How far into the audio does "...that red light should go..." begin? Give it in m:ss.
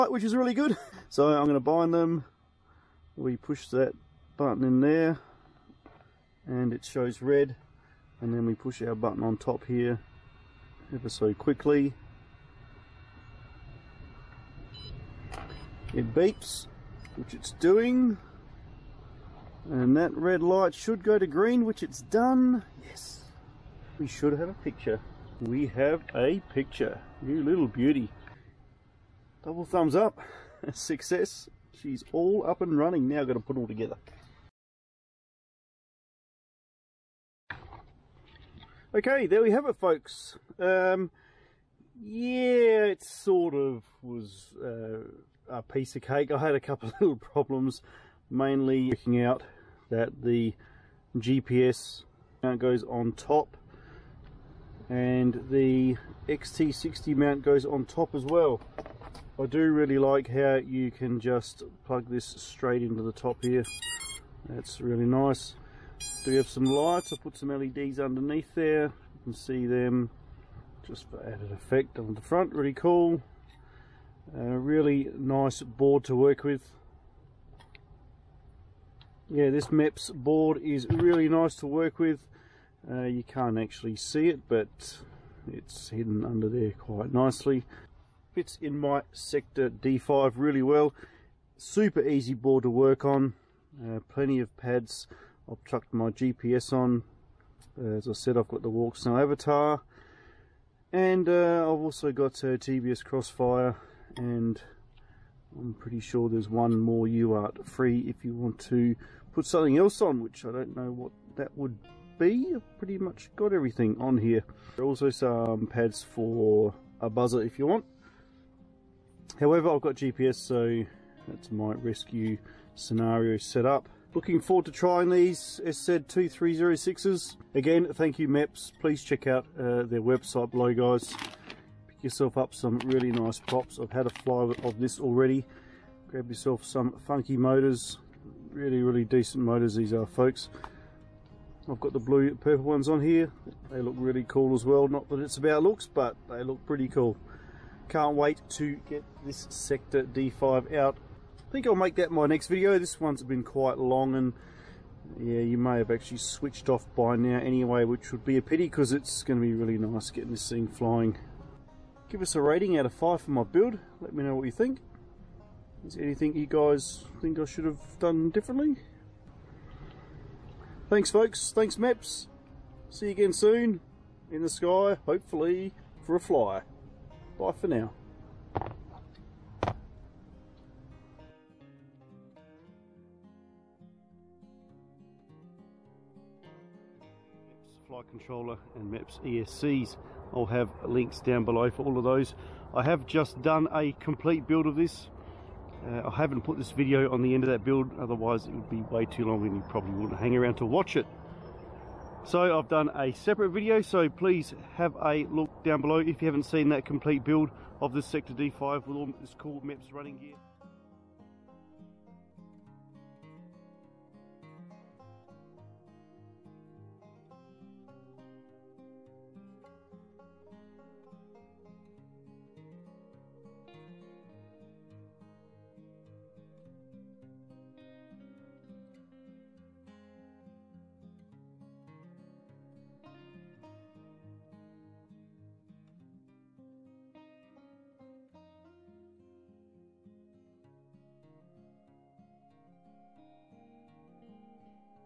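0:19.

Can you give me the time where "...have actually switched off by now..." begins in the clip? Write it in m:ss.
2:35.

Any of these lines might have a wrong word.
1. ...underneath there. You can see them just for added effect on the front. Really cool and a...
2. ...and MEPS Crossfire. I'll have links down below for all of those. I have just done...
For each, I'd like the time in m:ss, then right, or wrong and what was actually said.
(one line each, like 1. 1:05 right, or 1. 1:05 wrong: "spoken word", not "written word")
1. 1:07 right
2. 3:08 wrong: "ESCs", not "Crossfire".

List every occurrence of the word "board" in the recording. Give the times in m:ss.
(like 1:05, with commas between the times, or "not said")
1:15, 1:20, 1:32.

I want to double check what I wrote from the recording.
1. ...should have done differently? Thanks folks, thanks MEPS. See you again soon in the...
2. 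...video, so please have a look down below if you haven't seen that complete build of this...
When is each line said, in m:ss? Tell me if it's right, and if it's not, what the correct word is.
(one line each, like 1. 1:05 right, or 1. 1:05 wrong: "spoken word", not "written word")
1. 2:47 right
2. 3:23 right.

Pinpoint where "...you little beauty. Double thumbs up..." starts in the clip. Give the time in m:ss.
0:27.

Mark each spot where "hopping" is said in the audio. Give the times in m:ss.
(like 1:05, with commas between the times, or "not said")
not said.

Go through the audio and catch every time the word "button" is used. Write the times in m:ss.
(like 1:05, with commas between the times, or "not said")
0:04, 0:08.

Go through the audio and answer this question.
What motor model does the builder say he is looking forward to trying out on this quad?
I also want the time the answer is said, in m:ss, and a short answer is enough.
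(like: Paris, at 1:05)
SZ2306, at 2:05.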